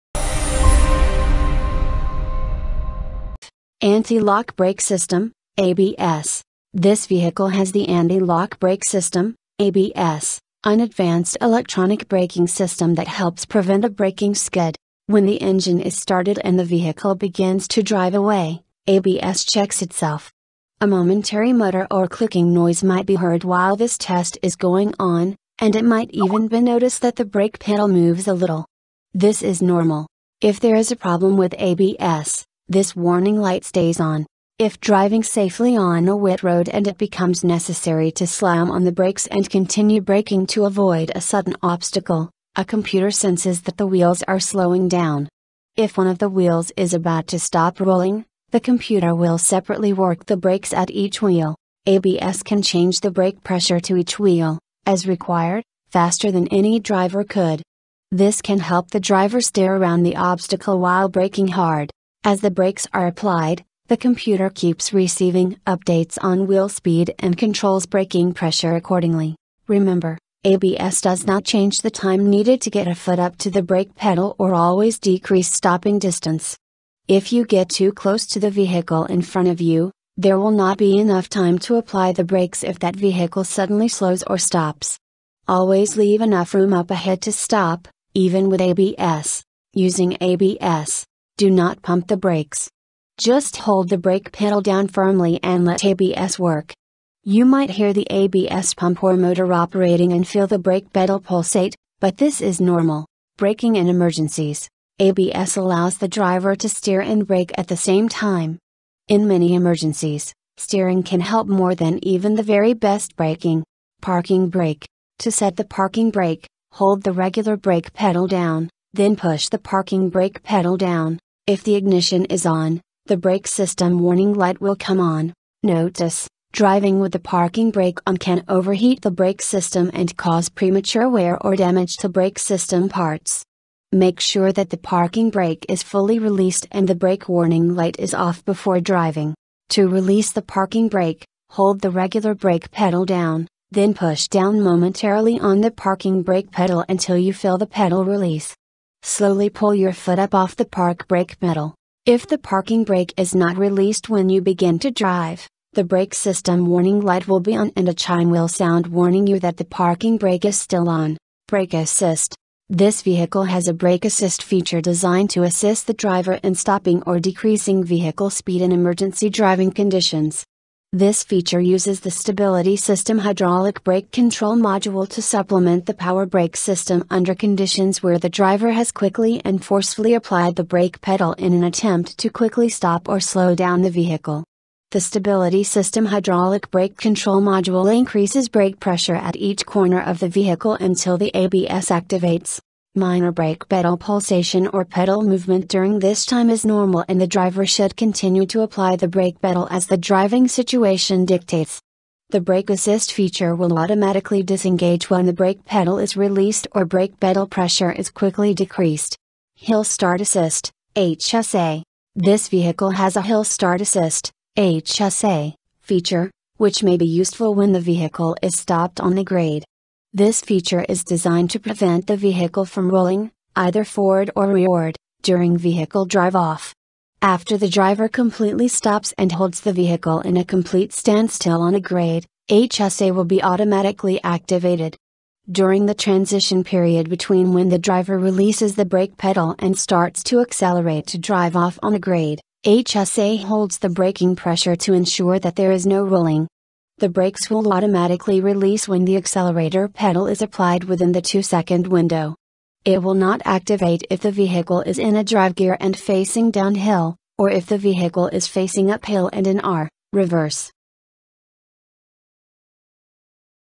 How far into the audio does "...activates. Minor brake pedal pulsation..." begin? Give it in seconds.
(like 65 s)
191 s.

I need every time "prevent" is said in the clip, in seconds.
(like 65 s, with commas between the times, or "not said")
13 s, 221 s.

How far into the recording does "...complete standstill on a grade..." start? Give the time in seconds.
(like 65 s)
230 s.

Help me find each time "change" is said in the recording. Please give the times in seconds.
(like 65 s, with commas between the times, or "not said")
52 s, 71 s.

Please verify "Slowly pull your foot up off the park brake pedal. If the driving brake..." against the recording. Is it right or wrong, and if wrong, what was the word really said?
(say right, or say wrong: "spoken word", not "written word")
wrong: "parking", not "driving".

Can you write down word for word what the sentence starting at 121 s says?
If the ignition is on, the brake system warning light will come on.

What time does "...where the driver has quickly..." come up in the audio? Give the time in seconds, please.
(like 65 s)
178 s.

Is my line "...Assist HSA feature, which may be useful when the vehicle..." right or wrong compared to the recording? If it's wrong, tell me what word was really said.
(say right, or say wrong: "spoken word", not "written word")
right.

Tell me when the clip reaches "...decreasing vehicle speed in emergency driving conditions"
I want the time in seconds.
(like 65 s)
167 s.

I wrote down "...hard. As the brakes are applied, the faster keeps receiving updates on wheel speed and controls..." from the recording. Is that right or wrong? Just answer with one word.
wrong.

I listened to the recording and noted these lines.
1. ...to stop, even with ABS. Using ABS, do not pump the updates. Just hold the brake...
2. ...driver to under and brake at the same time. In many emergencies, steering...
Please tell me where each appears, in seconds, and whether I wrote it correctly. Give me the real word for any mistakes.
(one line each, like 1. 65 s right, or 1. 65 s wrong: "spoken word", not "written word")
1. 87 s wrong: "brakes", not "updates"
2. 106 s wrong: "steer", not "under".